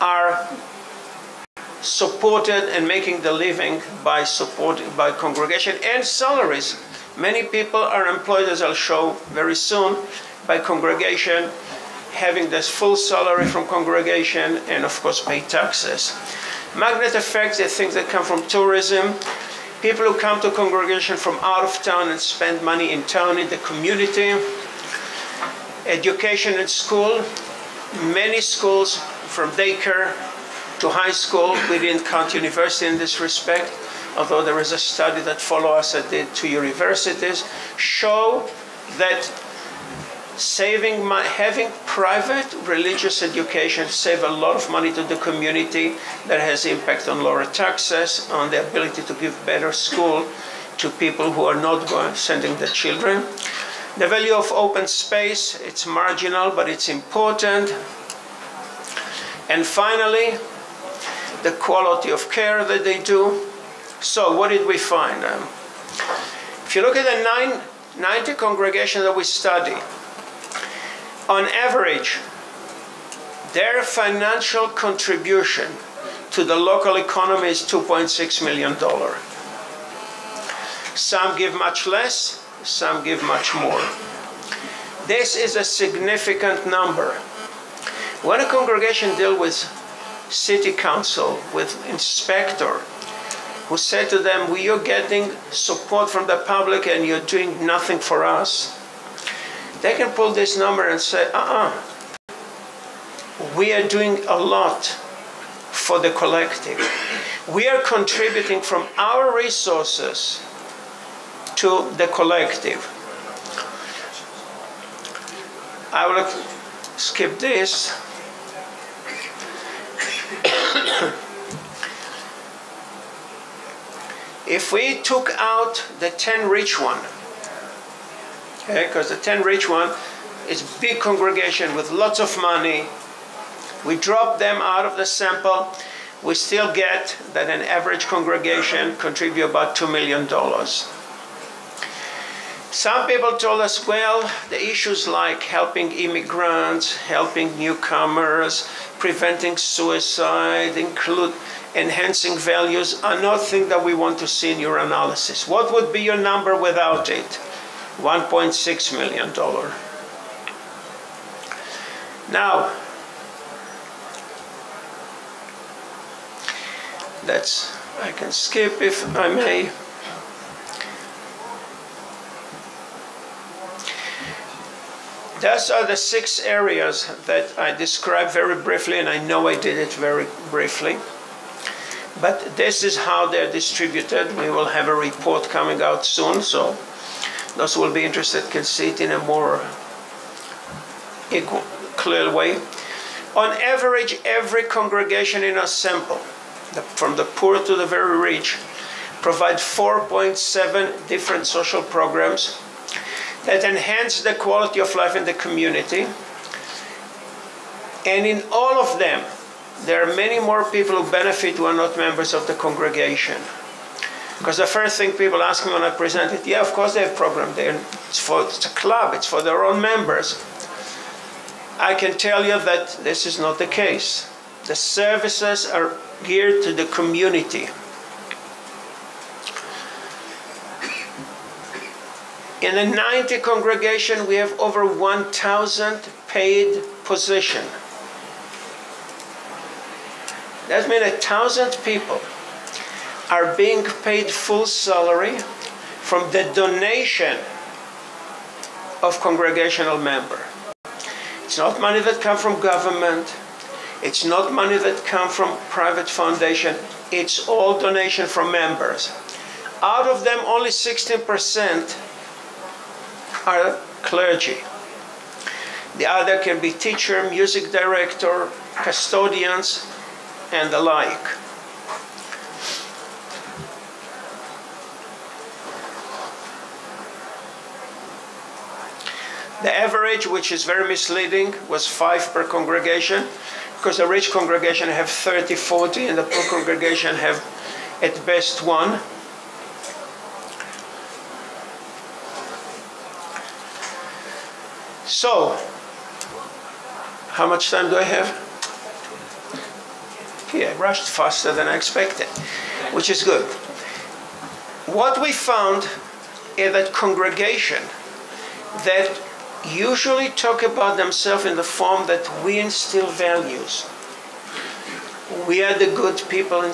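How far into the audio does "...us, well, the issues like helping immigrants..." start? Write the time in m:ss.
2:23.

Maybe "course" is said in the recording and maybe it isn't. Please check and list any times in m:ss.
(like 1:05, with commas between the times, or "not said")
0:15, 3:36.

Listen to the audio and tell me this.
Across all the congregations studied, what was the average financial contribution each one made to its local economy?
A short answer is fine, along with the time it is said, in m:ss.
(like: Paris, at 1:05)
$2.6 million, at 1:17.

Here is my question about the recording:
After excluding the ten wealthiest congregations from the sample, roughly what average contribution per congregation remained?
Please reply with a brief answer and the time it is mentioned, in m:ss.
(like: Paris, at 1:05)
$2 million, at 2:19.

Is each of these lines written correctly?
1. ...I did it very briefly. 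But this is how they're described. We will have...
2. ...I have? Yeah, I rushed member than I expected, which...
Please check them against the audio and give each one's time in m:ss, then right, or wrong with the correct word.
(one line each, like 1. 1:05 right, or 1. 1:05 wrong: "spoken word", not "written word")
1. 2:59 wrong: "distributed", not "described"
2. 4:57 wrong: "faster", not "member".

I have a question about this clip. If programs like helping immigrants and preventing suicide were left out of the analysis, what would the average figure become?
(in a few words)
$1.6 million.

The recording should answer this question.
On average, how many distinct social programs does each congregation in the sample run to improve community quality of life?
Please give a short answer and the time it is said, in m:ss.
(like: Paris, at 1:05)
4.7, at 3:19.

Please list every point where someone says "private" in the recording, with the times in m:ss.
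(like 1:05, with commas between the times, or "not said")
0:41, 4:15.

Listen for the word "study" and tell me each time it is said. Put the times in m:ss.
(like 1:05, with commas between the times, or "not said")
0:34, 1:09.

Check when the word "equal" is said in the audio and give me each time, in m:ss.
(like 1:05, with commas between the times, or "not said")
3:11.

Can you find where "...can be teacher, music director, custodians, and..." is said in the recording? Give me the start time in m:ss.
4:26.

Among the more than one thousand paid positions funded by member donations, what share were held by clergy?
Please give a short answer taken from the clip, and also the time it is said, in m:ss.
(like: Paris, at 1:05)
16 percent, at 4:20.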